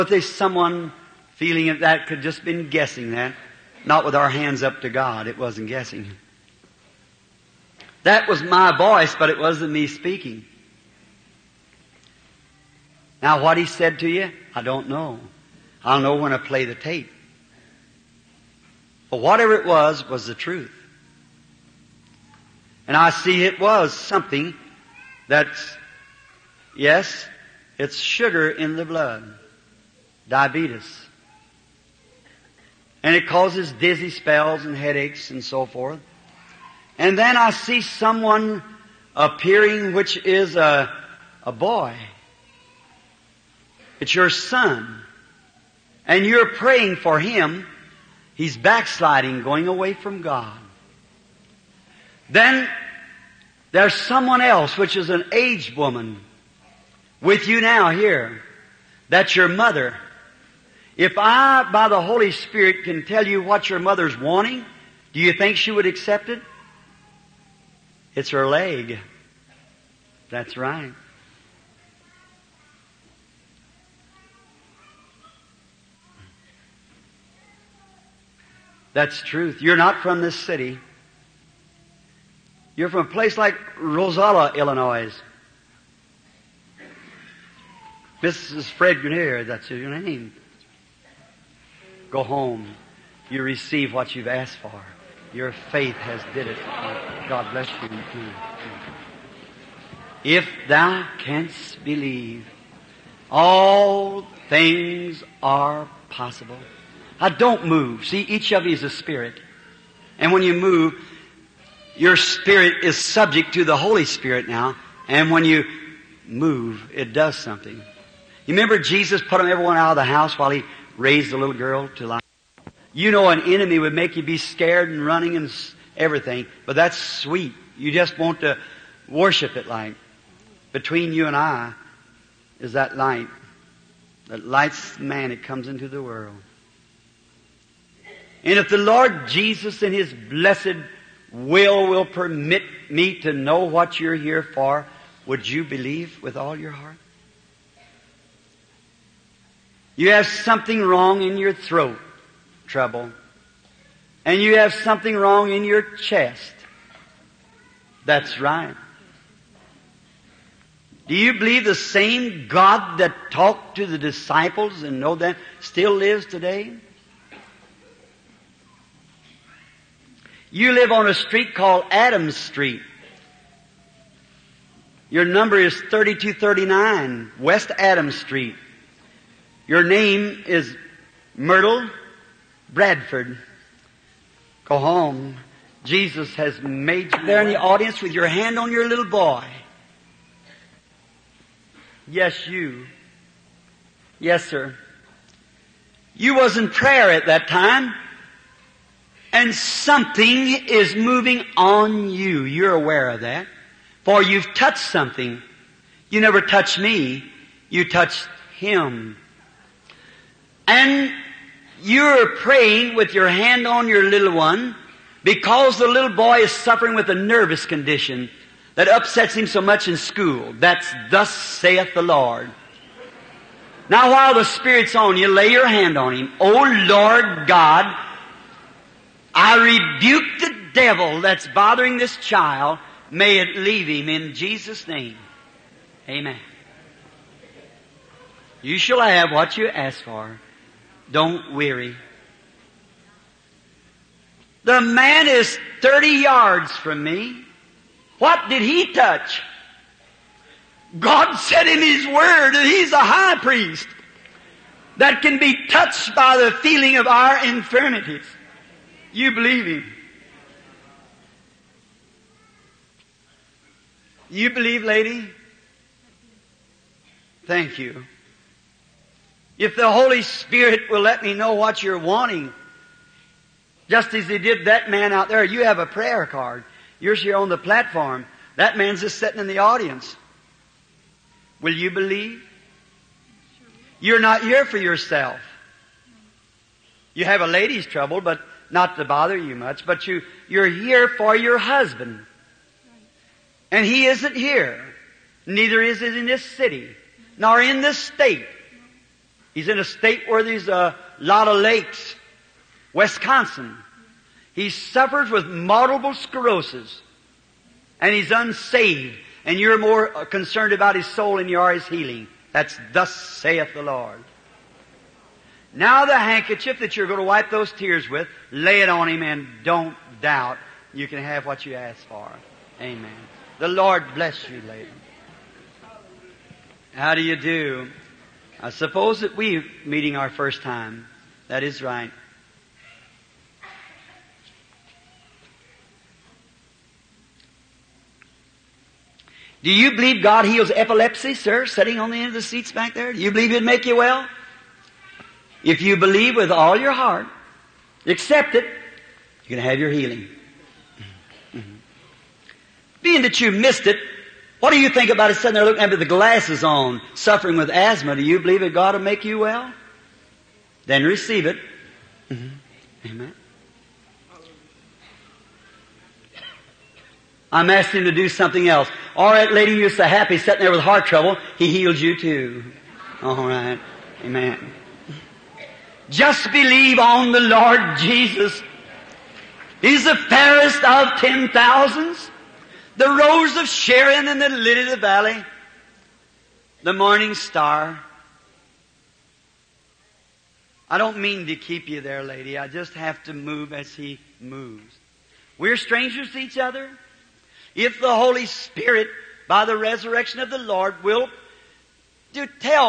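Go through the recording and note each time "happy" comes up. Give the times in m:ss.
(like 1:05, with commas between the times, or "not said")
6:10.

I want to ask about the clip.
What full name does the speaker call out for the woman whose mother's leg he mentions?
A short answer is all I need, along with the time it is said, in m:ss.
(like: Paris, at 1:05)
Mrs. Fred Grenier, at 1:28.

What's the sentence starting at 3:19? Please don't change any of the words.
And something is moving on you.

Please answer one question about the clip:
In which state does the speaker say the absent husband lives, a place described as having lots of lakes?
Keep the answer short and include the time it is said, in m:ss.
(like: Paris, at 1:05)
Wisconsin, at 5:02.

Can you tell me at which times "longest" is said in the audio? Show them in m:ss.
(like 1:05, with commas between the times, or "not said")
not said.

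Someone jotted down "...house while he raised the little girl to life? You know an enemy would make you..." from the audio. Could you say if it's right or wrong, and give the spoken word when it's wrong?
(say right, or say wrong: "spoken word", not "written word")
right.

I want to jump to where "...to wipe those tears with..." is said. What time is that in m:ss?
5:17.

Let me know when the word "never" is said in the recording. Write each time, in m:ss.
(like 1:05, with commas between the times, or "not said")
3:26.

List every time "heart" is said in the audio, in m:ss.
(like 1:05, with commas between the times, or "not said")
2:26, 5:46, 6:10.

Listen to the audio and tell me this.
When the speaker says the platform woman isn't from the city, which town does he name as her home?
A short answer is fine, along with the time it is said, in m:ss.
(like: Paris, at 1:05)
Rosala, Illinois, at 1:23.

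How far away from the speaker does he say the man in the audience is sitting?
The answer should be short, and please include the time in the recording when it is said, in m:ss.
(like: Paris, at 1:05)
30 yards, at 4:05.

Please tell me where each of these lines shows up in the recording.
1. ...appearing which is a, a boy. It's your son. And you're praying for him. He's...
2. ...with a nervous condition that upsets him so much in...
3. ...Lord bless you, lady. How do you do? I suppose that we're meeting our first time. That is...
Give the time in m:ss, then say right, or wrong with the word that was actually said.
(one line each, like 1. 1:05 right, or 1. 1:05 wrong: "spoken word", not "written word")
1. 0:39 right
2. 3:36 right
3. 5:23 right.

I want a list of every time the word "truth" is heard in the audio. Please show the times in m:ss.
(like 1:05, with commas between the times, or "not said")
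0:20, 1:19.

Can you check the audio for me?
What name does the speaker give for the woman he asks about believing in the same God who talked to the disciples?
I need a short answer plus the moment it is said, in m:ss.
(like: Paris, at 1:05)
Myrtle Bradford, at 3:01.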